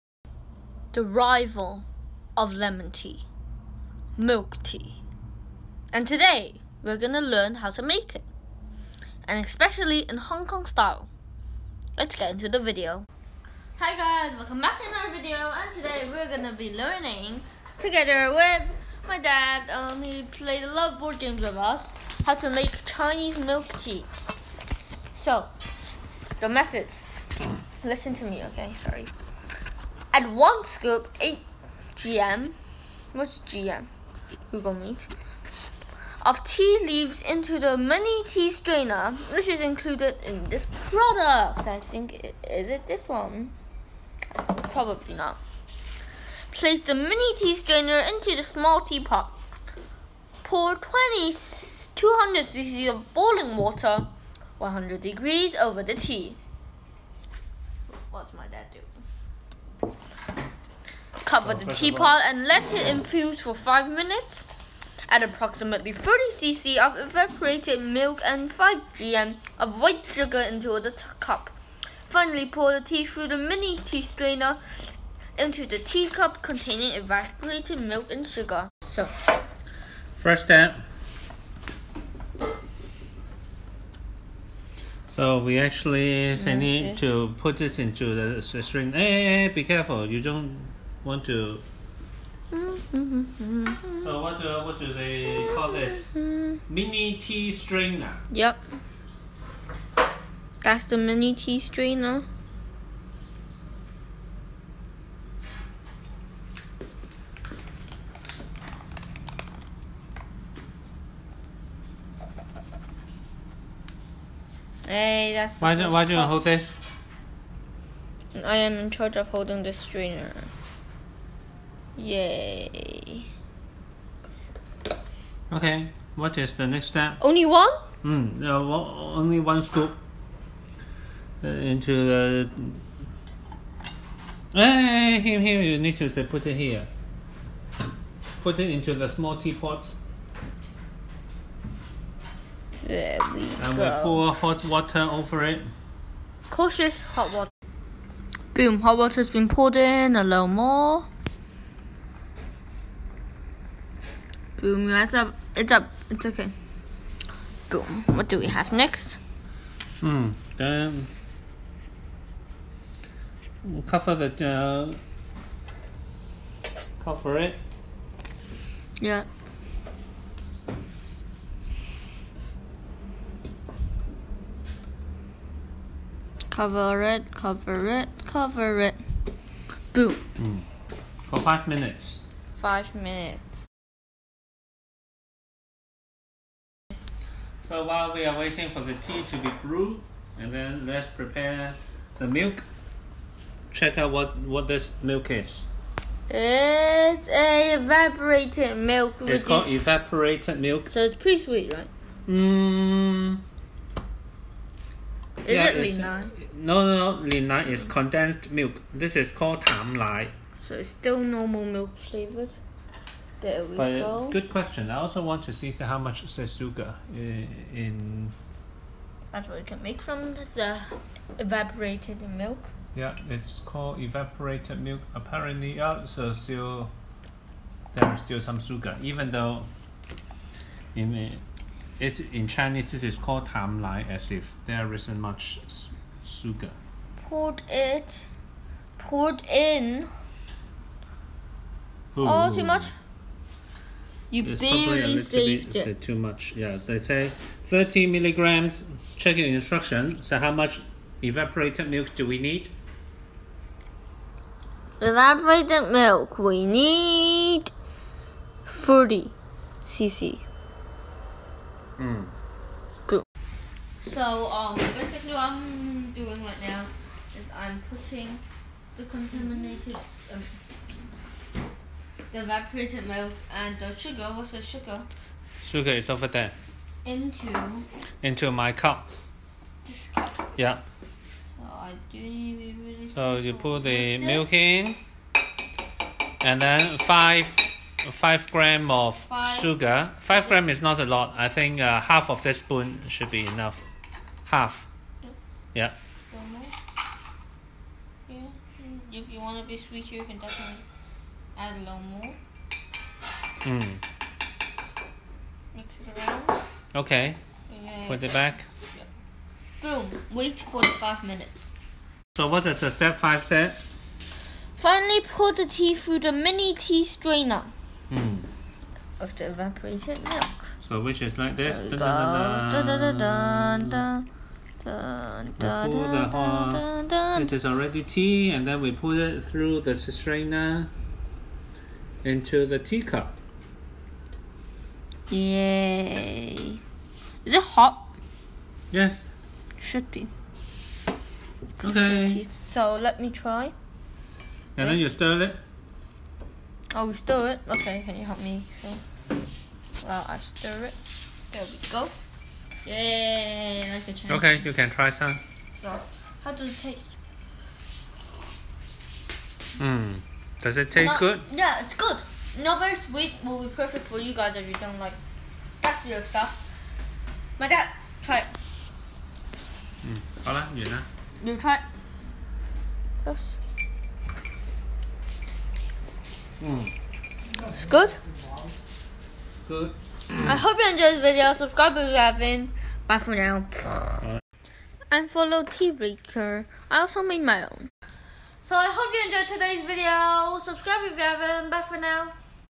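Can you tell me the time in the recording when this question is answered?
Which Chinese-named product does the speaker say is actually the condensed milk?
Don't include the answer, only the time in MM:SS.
03:27.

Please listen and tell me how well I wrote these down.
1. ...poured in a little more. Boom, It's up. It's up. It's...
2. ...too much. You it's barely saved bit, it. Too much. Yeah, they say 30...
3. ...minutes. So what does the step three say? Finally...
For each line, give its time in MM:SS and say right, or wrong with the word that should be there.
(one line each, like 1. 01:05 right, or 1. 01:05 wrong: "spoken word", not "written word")
1. 02:29 right
2. 04:02 right
3. 05:11 wrong: "five", not "three".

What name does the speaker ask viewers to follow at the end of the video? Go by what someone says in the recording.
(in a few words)
Tea Breaker.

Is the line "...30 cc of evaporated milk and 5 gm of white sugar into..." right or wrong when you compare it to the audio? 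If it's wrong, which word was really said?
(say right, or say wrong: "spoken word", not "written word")
right.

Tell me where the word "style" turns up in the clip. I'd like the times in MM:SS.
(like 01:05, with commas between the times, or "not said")
00:10.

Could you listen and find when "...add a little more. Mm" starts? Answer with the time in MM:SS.
05:01.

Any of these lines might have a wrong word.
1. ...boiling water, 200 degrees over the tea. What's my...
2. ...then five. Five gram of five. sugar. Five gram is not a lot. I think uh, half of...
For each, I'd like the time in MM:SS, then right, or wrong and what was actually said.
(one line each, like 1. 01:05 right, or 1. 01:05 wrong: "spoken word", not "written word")
1. 00:53 wrong: "100", not "200"
2. 04:46 right.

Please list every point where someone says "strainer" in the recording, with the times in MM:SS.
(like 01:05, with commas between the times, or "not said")
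00:38, 00:47, 01:14, 01:37, 01:41, 01:59, 05:17, 05:29.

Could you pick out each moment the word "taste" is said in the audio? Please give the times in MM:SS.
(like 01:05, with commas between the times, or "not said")
05:56, 06:00.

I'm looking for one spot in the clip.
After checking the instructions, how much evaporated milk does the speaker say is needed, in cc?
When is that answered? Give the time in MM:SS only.
04:18.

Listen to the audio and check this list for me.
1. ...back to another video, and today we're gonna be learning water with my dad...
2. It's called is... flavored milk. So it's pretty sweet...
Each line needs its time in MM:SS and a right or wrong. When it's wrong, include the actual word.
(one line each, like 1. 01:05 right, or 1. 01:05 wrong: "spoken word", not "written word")
1. 00:14 wrong: "together", not "water"
2. 03:19 wrong: "evaporated", not "flavored".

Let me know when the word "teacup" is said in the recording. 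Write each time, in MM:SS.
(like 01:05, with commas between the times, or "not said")
01:15, 05:32.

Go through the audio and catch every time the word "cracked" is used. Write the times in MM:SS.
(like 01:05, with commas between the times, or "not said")
not said.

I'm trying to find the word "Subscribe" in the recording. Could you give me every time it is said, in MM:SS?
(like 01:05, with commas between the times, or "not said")
06:21, 06:30.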